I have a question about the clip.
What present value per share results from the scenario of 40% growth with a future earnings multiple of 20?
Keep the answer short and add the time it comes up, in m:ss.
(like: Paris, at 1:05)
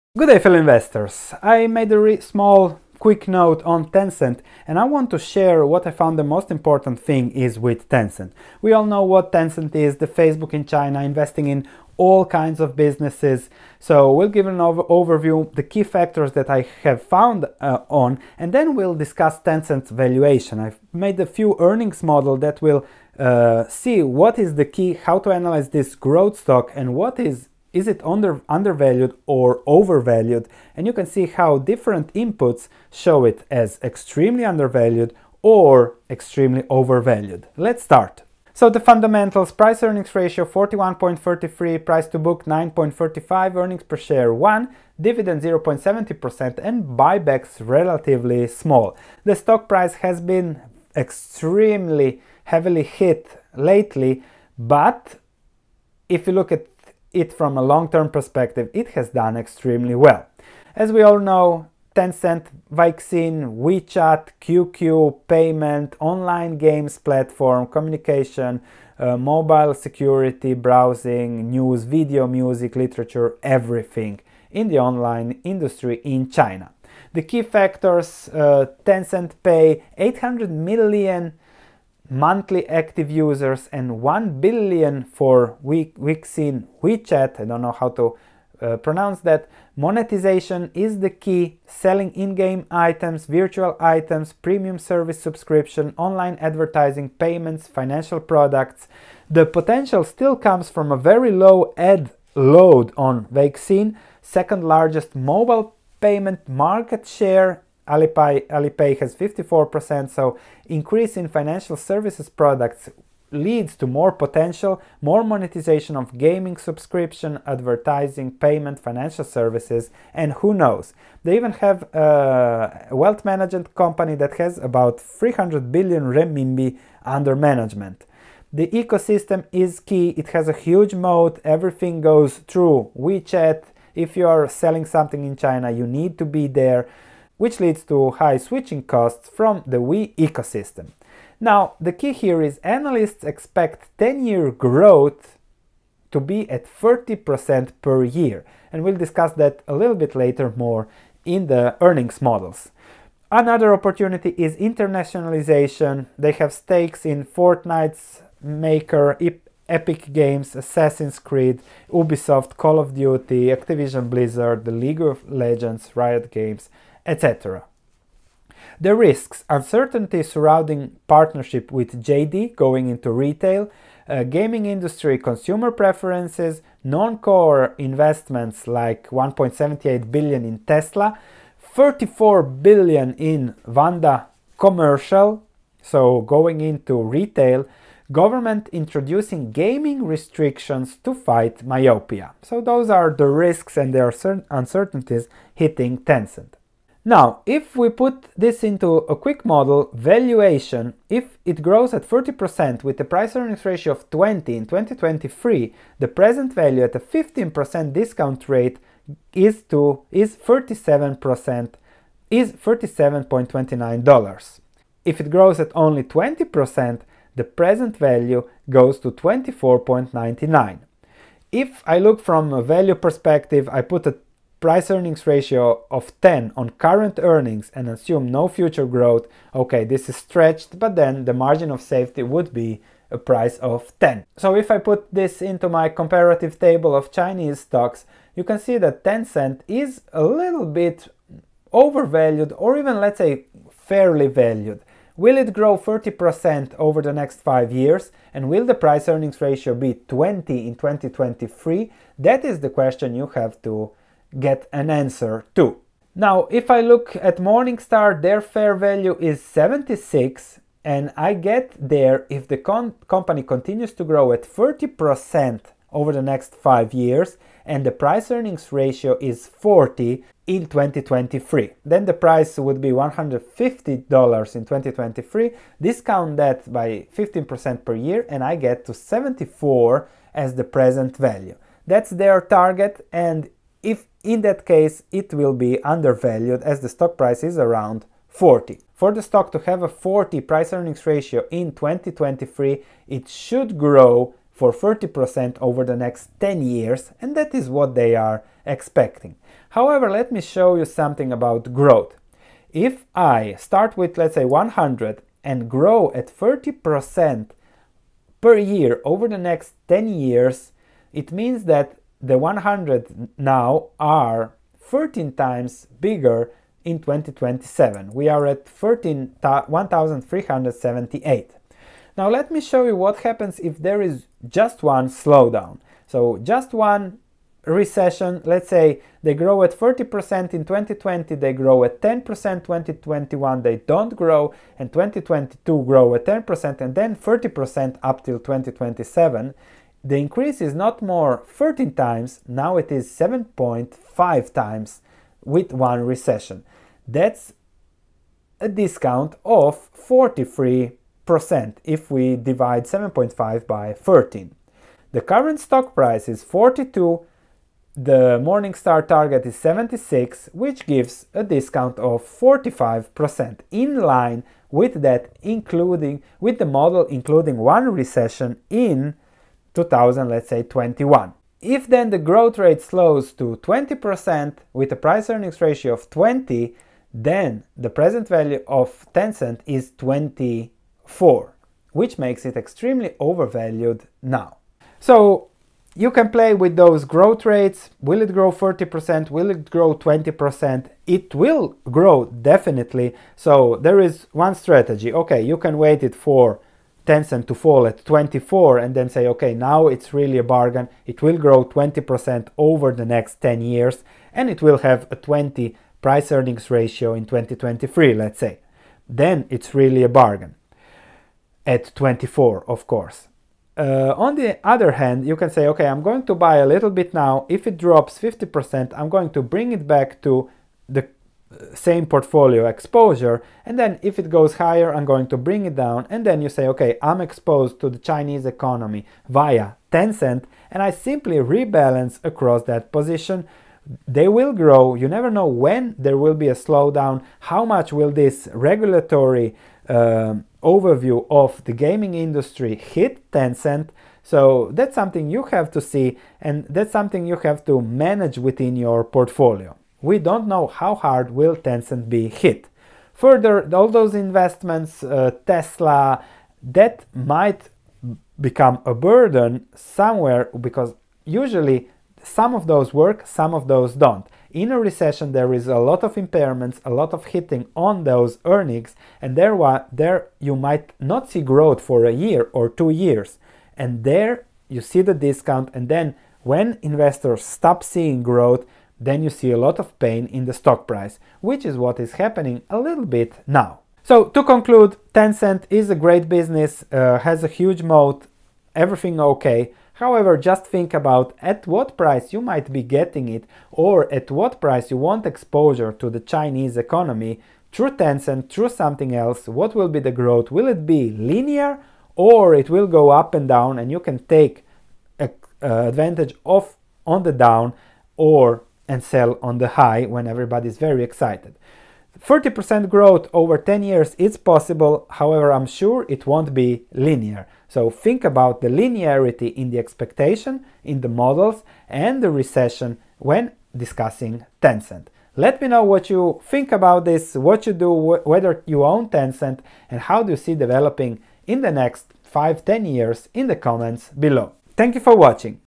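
$37.29, at 3:32.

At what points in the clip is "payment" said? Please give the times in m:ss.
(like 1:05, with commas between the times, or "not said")
1:05, 1:37, 1:46, 1:58.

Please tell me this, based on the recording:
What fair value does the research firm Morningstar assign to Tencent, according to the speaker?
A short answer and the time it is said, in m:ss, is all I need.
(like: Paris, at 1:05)
76, at 4:18.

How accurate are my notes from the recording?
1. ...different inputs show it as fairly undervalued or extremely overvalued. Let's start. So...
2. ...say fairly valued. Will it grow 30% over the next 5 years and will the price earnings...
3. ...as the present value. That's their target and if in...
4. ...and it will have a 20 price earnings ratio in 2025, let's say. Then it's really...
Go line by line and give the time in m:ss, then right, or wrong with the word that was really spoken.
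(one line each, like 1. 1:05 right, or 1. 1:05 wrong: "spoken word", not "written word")
1. 0:31 wrong: "extremely", not "fairly"
2. 4:03 right
3. 4:40 right
4. 6:44 wrong: "2023", not "2025".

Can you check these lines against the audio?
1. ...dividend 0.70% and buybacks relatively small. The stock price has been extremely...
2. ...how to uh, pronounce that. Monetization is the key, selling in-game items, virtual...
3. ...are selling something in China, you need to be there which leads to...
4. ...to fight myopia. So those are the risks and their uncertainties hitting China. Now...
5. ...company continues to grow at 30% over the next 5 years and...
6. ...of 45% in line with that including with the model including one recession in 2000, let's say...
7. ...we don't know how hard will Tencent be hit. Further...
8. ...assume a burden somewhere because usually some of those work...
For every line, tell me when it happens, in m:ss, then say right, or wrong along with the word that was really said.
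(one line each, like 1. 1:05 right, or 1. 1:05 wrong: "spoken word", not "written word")
1. 0:44 right
2. 1:27 right
3. 2:14 right
4. 3:11 wrong: "Tencent", not "China"
5. 4:23 right
6. 6:01 right
7. 7:30 right
8. 7:38 wrong: "become", not "assume".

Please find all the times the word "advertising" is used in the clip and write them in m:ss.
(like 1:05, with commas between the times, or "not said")
1:36, 1:57.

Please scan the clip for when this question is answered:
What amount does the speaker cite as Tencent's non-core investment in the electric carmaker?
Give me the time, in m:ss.
2:59.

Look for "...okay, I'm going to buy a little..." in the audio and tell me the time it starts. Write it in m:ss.
6:55.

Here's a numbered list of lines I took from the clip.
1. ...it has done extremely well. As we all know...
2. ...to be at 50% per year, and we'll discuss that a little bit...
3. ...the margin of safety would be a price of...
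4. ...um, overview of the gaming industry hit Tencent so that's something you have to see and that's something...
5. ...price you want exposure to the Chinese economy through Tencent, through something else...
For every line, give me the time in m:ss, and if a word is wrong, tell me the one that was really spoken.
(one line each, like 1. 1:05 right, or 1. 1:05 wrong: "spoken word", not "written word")
1. 0:58 right
2. 2:26 wrong: "30", not "50"
3. 3:51 right
4. 7:19 right
5. 8:14 right.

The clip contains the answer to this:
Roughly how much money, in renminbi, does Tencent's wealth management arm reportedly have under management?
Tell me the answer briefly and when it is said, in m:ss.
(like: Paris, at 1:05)
300 billion, at 2:04.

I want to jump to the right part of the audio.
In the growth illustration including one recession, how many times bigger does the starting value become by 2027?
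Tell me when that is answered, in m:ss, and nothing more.
5:43.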